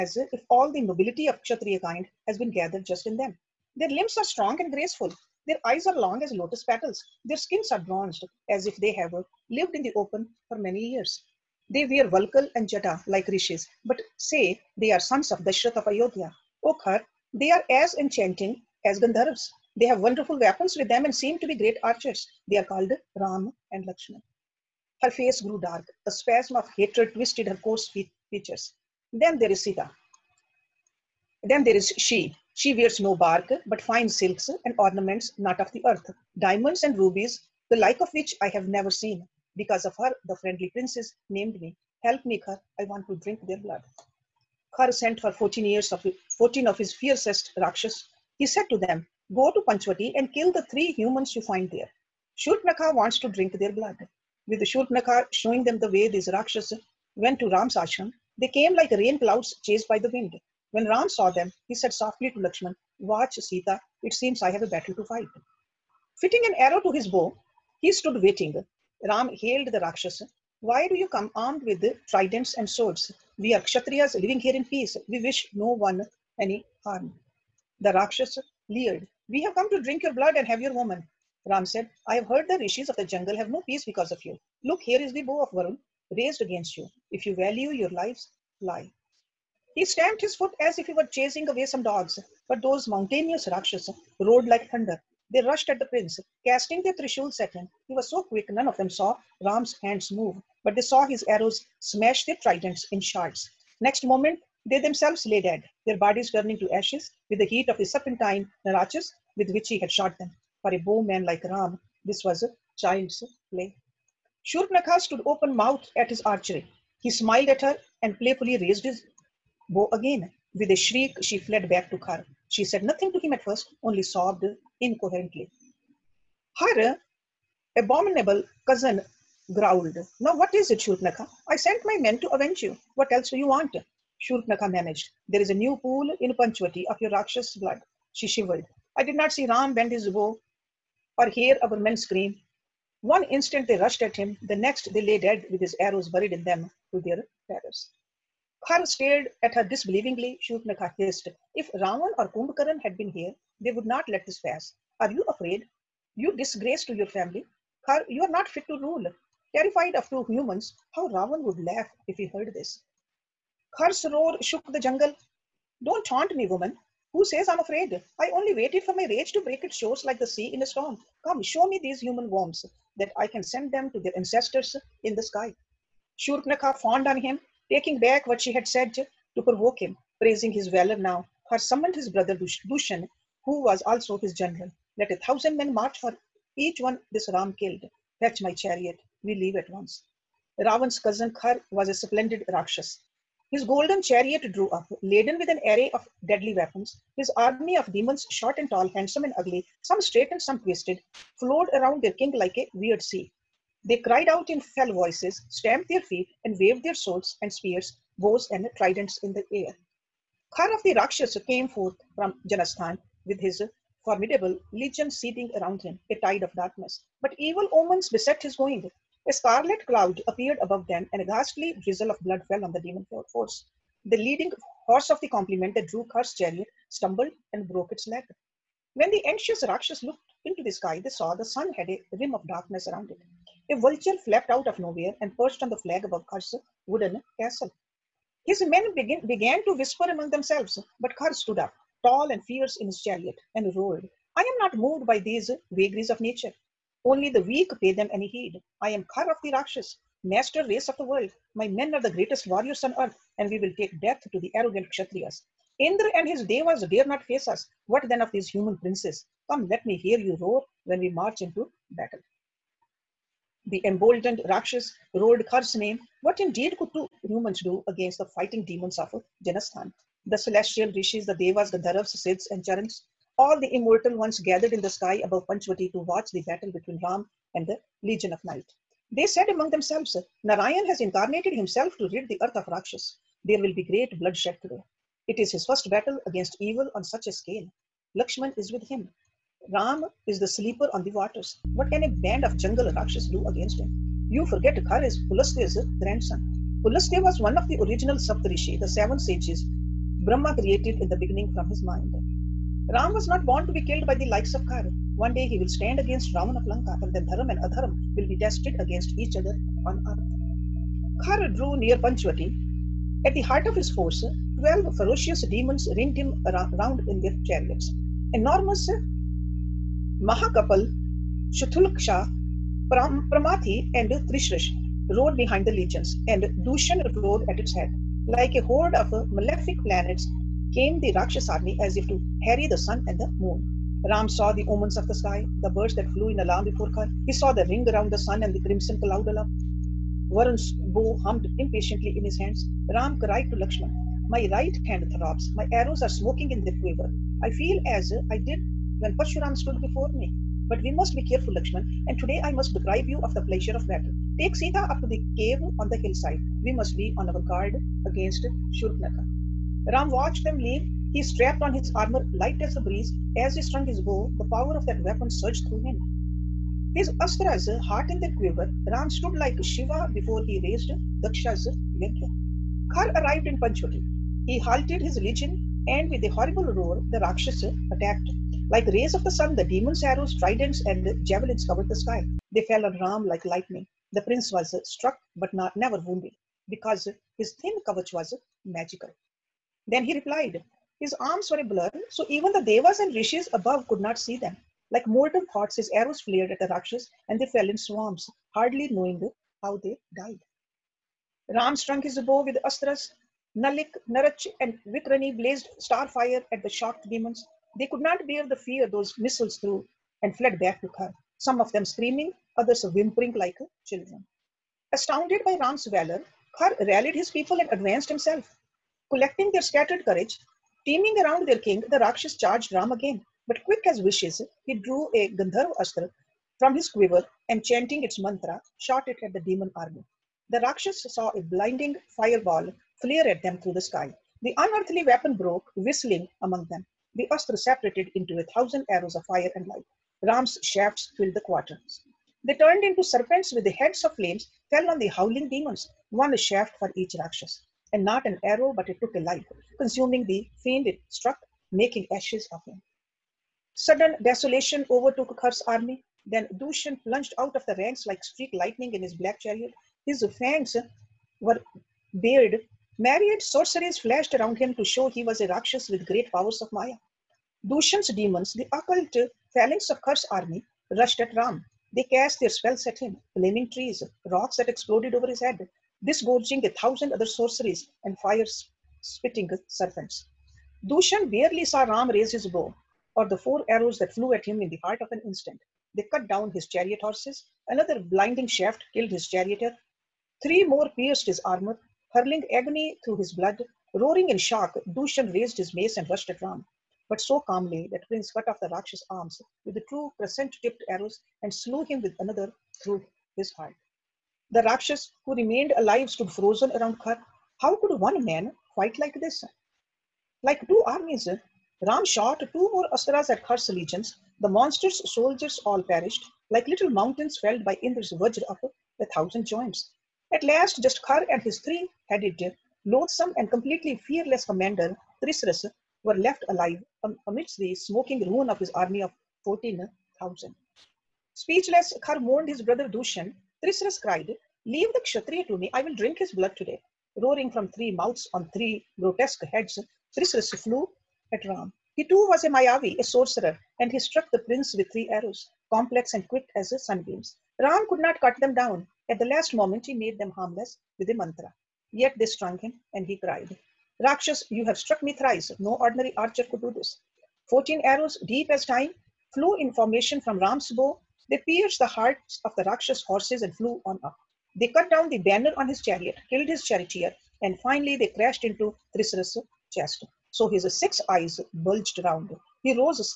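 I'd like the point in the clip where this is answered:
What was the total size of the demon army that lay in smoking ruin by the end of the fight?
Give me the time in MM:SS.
08:49.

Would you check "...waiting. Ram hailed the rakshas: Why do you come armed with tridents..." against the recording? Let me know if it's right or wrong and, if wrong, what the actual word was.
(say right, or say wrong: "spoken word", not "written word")
right.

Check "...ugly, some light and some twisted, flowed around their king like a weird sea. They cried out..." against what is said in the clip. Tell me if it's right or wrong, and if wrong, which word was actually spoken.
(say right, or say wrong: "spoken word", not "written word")
wrong: "straight", not "light".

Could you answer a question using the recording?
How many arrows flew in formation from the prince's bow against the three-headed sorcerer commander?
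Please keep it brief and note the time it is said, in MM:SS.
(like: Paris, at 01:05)
14, at 09:17.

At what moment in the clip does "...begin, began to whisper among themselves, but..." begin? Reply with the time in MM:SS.
03:58.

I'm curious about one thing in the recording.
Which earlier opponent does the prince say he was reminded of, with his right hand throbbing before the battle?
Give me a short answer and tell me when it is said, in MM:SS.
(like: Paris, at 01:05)
Parshuram, at 05:49.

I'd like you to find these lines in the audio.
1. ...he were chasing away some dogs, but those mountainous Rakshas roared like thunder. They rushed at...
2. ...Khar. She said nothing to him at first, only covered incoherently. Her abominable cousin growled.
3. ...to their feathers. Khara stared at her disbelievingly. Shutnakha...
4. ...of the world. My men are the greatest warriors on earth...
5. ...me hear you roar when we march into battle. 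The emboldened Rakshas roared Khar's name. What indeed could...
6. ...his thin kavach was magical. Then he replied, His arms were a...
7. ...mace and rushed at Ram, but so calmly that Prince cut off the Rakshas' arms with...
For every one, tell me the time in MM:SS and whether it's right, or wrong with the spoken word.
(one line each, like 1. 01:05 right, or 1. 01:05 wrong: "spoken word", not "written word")
1. 01:30 right
2. 02:01 wrong: "sobbed", not "covered"
3. 02:26 right
4. 04:10 right
5. 04:19 right
6. 06:27 right
7. 08:15 right.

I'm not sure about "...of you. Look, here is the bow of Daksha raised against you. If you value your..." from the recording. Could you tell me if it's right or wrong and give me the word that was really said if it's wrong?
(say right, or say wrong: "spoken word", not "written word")
wrong: "Varun", not "Daksha".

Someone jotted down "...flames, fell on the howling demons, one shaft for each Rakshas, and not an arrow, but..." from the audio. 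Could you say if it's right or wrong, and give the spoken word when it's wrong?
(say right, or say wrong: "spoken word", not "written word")
right.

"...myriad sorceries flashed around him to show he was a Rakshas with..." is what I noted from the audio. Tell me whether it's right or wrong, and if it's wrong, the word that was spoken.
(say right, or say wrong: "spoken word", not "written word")
right.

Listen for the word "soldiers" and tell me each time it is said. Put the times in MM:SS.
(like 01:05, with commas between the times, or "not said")
08:35.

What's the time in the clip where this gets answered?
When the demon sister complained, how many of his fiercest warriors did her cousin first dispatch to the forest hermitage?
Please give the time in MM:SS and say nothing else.
00:46.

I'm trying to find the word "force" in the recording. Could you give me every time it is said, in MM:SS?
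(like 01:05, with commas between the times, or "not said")
03:43, 05:13.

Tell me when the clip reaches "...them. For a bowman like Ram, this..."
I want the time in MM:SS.
01:50.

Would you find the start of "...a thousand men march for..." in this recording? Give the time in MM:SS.
03:05.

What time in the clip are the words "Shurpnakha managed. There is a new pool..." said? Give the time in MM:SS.
02:14.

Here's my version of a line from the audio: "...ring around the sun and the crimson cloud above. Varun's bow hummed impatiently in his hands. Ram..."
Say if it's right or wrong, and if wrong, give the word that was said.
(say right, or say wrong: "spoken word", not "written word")
right.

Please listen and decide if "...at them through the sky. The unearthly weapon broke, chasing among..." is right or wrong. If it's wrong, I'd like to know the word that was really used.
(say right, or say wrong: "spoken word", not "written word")
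wrong: "whistling", not "chasing".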